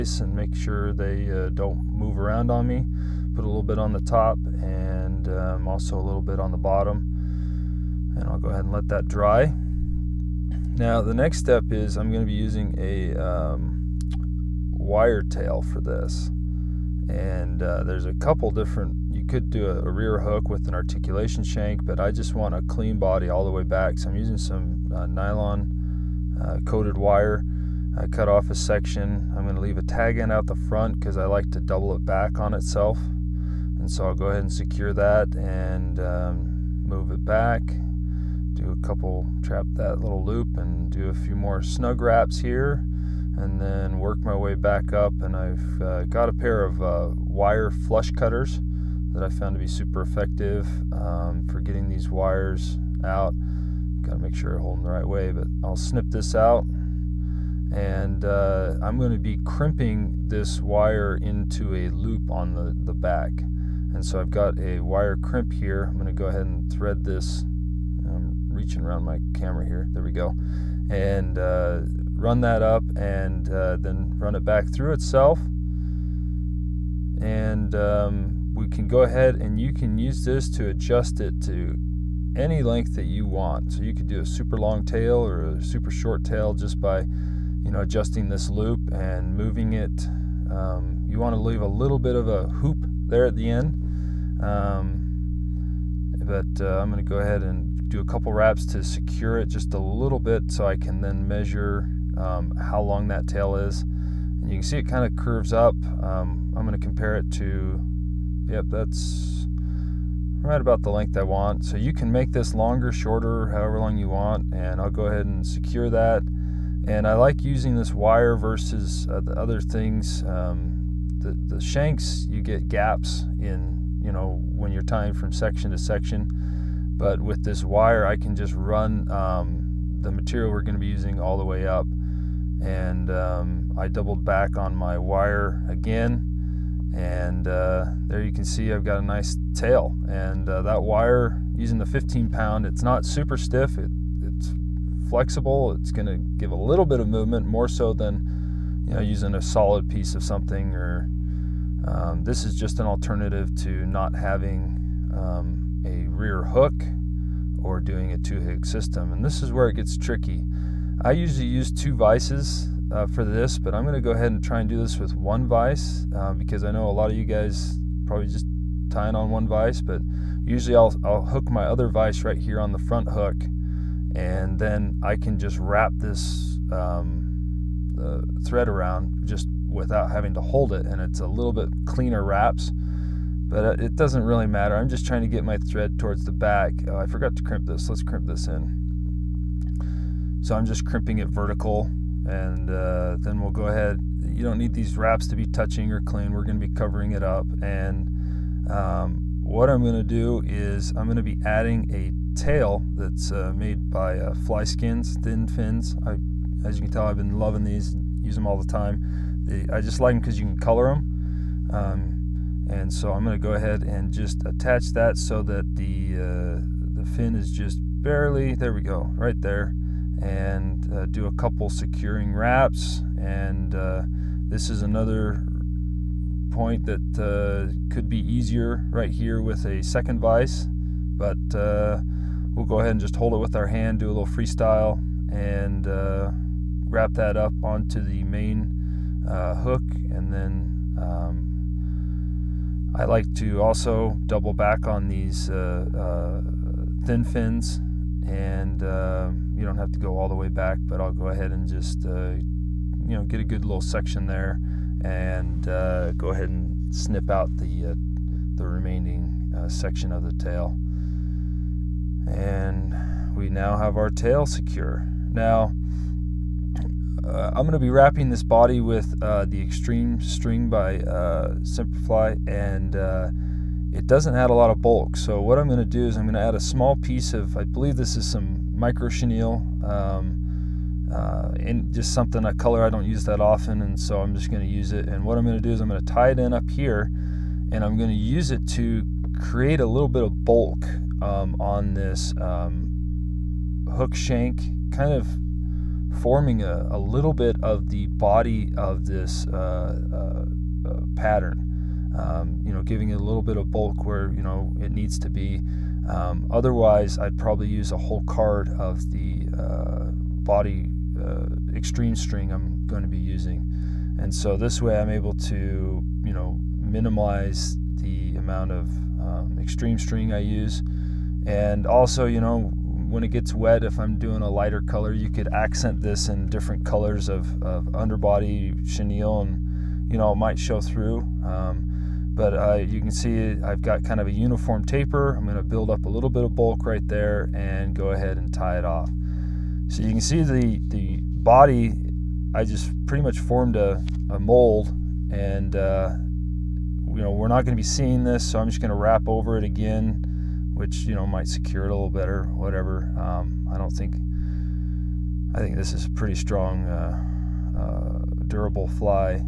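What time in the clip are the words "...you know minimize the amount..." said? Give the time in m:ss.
5:16.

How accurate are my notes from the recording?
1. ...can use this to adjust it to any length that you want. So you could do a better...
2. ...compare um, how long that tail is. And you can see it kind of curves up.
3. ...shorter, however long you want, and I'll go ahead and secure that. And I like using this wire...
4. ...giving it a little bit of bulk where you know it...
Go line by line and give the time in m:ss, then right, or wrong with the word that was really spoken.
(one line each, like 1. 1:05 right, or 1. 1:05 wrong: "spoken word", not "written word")
1. 1:19 wrong: "super", not "better"
2. 1:41 wrong: "measure", not "compare"
3. 1:52 right
4. 5:02 right.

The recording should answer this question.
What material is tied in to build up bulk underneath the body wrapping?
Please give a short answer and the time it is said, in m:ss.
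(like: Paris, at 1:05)
micro chenille, at 4:38.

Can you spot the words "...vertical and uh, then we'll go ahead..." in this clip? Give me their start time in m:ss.
3:11.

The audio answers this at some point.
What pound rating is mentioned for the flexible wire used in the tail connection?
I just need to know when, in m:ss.
2:21.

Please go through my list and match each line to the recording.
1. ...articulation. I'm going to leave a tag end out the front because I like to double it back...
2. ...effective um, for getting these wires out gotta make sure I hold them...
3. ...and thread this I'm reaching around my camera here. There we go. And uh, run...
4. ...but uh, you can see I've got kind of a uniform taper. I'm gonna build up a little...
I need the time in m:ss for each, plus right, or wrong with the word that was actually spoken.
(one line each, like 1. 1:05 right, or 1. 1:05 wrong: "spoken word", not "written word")
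1. 0:28 wrong: "section", not "articulation"
2. 0:50 right
3. 1:06 right
4. 5:32 right.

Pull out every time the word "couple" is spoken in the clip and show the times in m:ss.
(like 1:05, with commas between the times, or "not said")
0:18, 0:38, 1:38, 3:41.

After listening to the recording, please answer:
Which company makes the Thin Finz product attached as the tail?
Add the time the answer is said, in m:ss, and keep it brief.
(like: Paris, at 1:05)
Fly Skins, at 3:24.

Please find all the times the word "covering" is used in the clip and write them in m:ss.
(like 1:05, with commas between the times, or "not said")
3:16.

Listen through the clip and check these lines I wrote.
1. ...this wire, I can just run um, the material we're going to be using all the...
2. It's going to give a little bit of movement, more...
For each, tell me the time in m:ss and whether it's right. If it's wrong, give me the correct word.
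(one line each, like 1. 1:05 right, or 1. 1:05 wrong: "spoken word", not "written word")
1. 2:07 right
2. 2:25 right.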